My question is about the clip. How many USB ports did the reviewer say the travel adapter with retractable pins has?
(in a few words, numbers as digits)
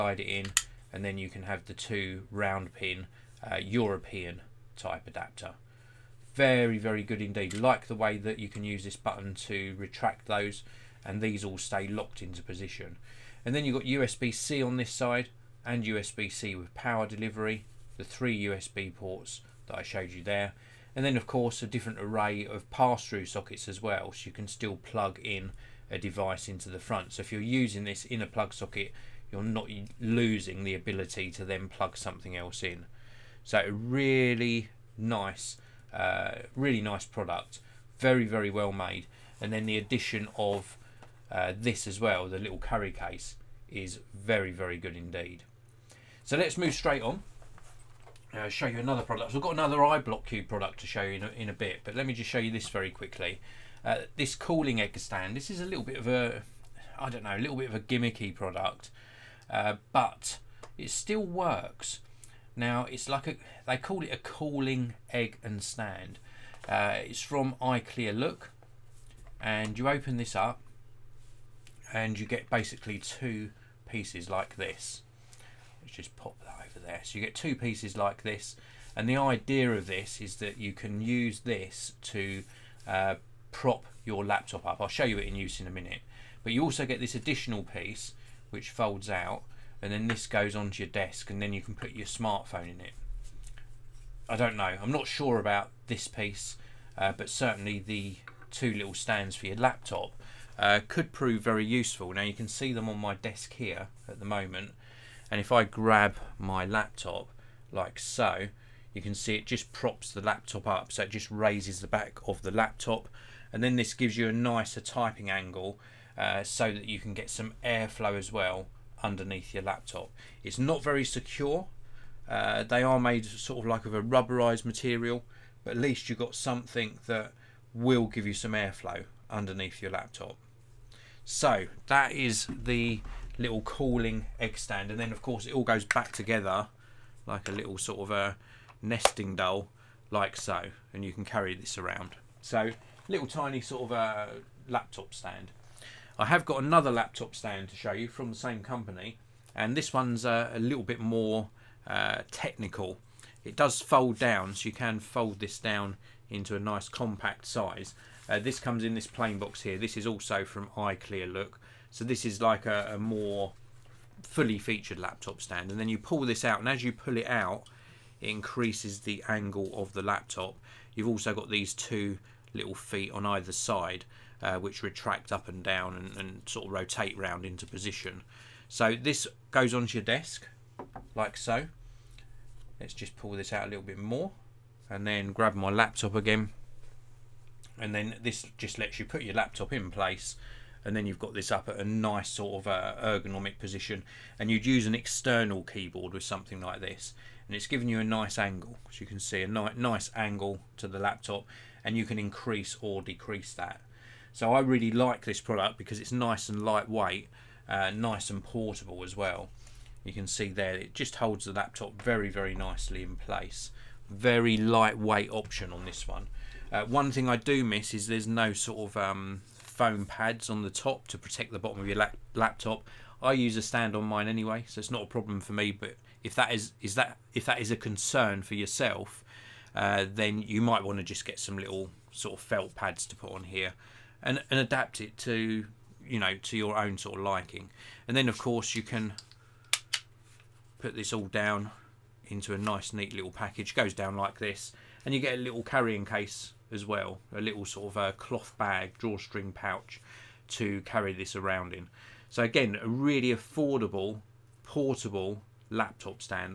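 3.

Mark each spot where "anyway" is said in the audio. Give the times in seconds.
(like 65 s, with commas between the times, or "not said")
224 s.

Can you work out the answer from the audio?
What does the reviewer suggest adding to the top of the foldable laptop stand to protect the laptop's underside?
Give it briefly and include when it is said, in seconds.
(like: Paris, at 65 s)
felt pads, at 232 s.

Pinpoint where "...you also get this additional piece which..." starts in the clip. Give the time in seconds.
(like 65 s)
86 s.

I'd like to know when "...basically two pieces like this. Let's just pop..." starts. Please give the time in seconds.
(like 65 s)
72 s.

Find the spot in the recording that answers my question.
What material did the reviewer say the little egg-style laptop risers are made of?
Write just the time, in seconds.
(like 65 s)
124 s.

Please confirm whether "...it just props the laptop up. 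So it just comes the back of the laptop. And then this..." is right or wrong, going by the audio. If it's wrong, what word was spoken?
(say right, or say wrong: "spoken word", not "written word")
wrong: "raises", not "comes".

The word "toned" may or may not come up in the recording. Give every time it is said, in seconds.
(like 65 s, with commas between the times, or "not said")
not said.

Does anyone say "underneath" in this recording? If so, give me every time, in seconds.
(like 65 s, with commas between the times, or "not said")
119 s, 129 s.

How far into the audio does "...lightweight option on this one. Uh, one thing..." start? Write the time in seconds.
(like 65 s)
214 s.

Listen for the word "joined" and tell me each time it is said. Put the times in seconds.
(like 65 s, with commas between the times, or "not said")
not said.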